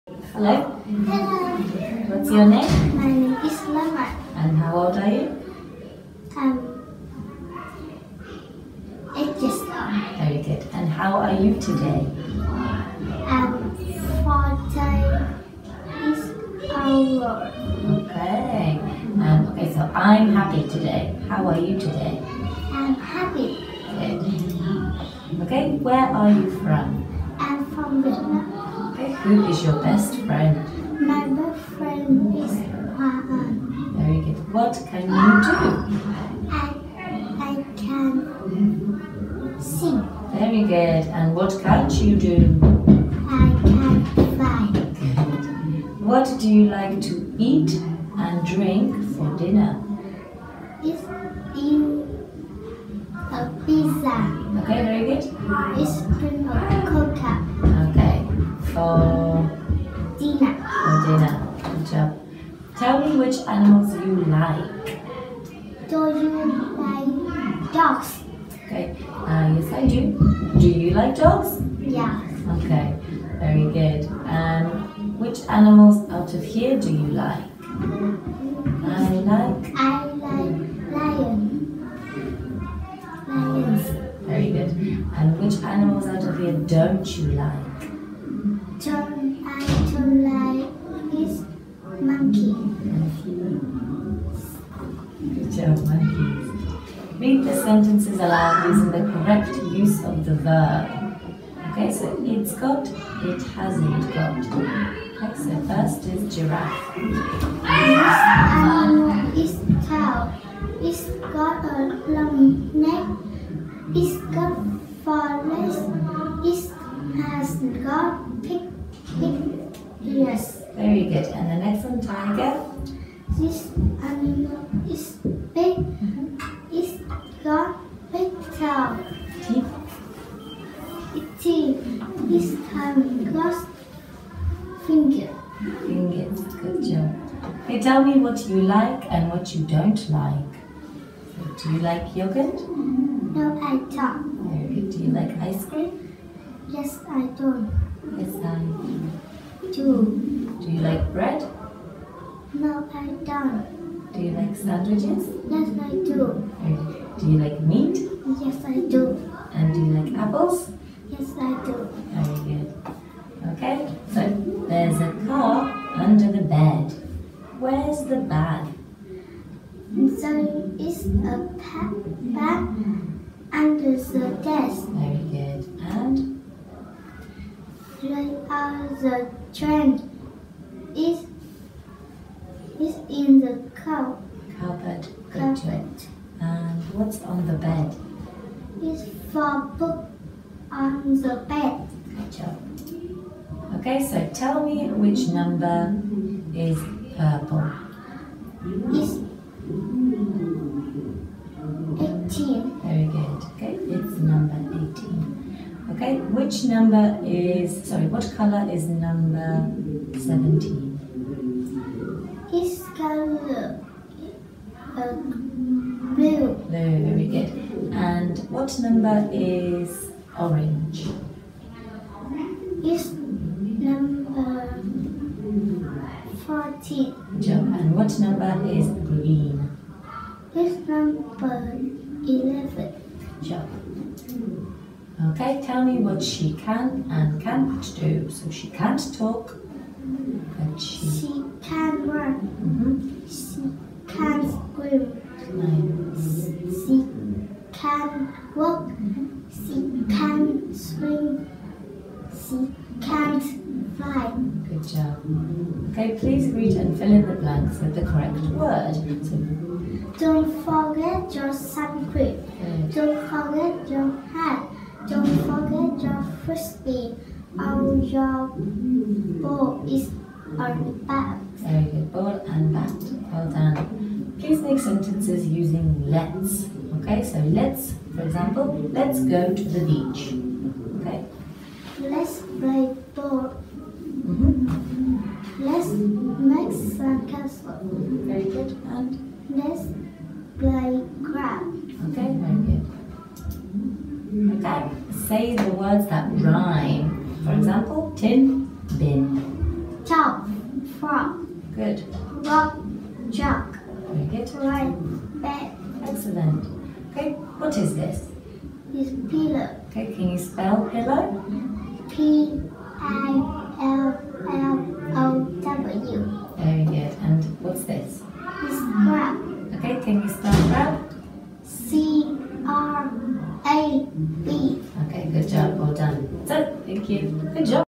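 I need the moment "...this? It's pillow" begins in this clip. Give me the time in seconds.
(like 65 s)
307 s.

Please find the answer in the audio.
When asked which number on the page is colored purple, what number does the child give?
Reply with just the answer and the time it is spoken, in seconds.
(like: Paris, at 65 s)
18, at 198 s.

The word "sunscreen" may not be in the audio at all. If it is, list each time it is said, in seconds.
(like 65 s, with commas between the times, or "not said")
261 s.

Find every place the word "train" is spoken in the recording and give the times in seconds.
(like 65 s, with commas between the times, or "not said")
179 s.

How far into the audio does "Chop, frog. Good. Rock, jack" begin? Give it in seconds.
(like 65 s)
300 s.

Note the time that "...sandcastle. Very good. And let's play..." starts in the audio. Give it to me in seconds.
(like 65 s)
286 s.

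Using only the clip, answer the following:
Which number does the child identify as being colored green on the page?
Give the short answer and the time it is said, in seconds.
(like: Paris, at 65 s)
11, at 230 s.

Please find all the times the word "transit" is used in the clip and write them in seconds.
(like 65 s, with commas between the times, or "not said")
not said.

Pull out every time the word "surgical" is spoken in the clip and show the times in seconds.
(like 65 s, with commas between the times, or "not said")
not said.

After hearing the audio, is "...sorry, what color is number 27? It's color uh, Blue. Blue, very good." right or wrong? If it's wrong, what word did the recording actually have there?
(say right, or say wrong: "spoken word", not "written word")
wrong: "17", not "27".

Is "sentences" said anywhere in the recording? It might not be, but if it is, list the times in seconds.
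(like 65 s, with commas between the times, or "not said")
97 s, 274 s.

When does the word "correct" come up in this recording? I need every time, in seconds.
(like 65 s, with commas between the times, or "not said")
99 s, 258 s.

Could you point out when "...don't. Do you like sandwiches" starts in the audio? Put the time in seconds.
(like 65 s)
153 s.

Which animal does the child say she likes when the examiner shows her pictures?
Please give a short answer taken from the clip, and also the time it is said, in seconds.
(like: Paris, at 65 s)
Lion, at 79 s.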